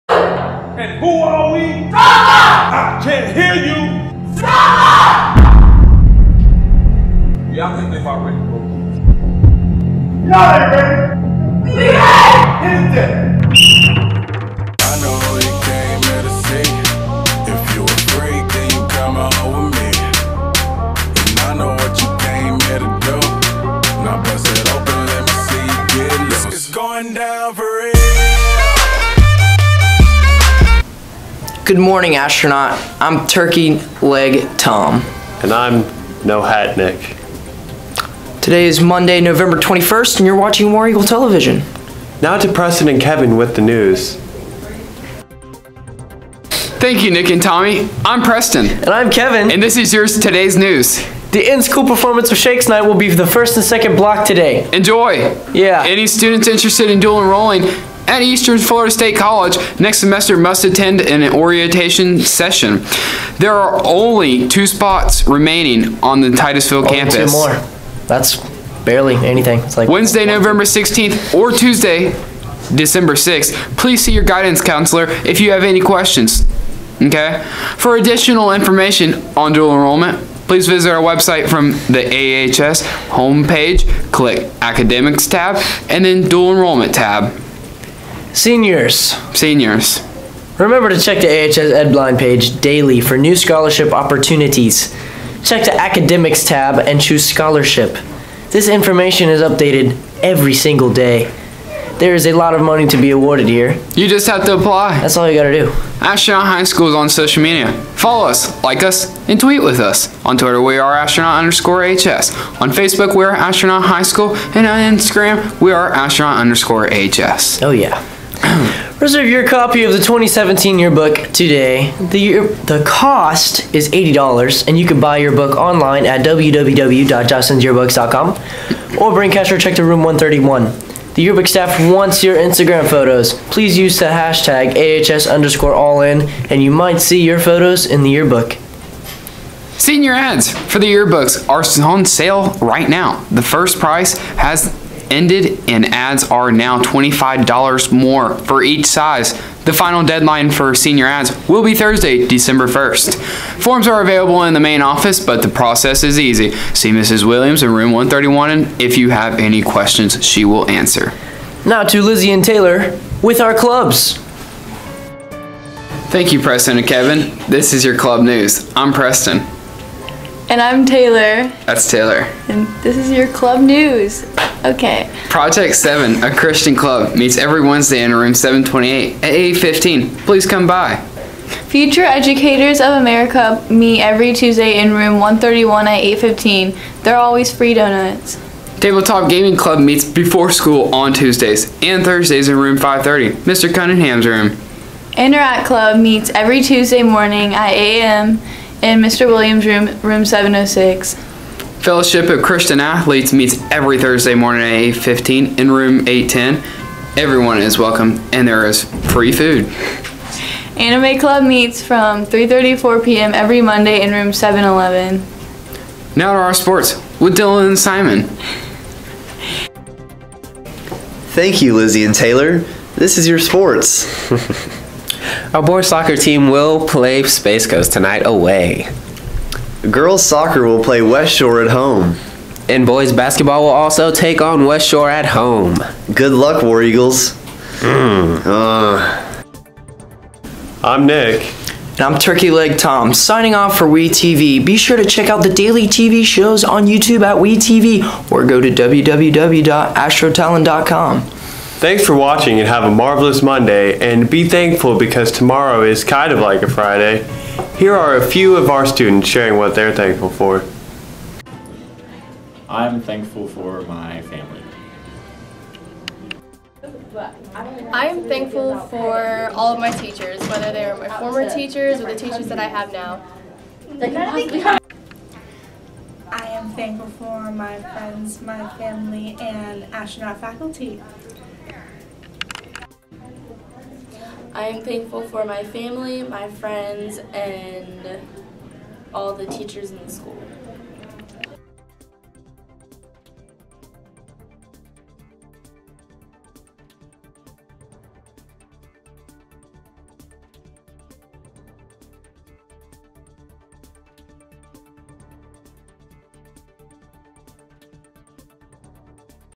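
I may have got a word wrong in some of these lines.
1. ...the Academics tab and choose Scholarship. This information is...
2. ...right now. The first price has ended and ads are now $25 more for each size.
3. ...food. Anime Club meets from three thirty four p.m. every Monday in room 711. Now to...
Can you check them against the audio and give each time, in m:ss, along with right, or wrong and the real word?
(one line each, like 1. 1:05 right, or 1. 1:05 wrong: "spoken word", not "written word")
1. 1:35 right
2. 2:22 right
3. 3:29 right.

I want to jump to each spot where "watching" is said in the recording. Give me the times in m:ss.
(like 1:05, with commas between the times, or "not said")
0:40, 4:12.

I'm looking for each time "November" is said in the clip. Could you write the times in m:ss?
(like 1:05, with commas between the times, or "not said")
0:39, 1:10.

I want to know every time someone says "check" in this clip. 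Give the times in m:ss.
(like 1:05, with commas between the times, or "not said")
1:30, 1:35, 2:09, 4:05.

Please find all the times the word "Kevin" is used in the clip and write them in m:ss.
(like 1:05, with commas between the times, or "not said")
0:42, 0:49, 2:46.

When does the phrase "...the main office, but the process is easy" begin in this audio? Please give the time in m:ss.
2:34.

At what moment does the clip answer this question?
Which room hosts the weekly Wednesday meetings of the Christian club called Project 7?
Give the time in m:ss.
2:58.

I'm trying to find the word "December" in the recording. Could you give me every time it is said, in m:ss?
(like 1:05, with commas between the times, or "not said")
1:12, 2:32.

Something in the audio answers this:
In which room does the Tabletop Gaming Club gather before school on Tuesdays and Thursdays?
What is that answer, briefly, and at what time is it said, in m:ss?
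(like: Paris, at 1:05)
Room 530, at 3:12.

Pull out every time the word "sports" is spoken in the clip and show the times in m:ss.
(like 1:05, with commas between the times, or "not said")
3:36, 3:43.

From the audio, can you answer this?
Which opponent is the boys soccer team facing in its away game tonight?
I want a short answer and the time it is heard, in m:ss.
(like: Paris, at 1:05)
Space Coast, at 3:47.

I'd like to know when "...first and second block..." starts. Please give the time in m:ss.
0:53.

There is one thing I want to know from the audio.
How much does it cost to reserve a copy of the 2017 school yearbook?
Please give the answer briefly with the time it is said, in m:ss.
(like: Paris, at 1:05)
$80, at 2:03.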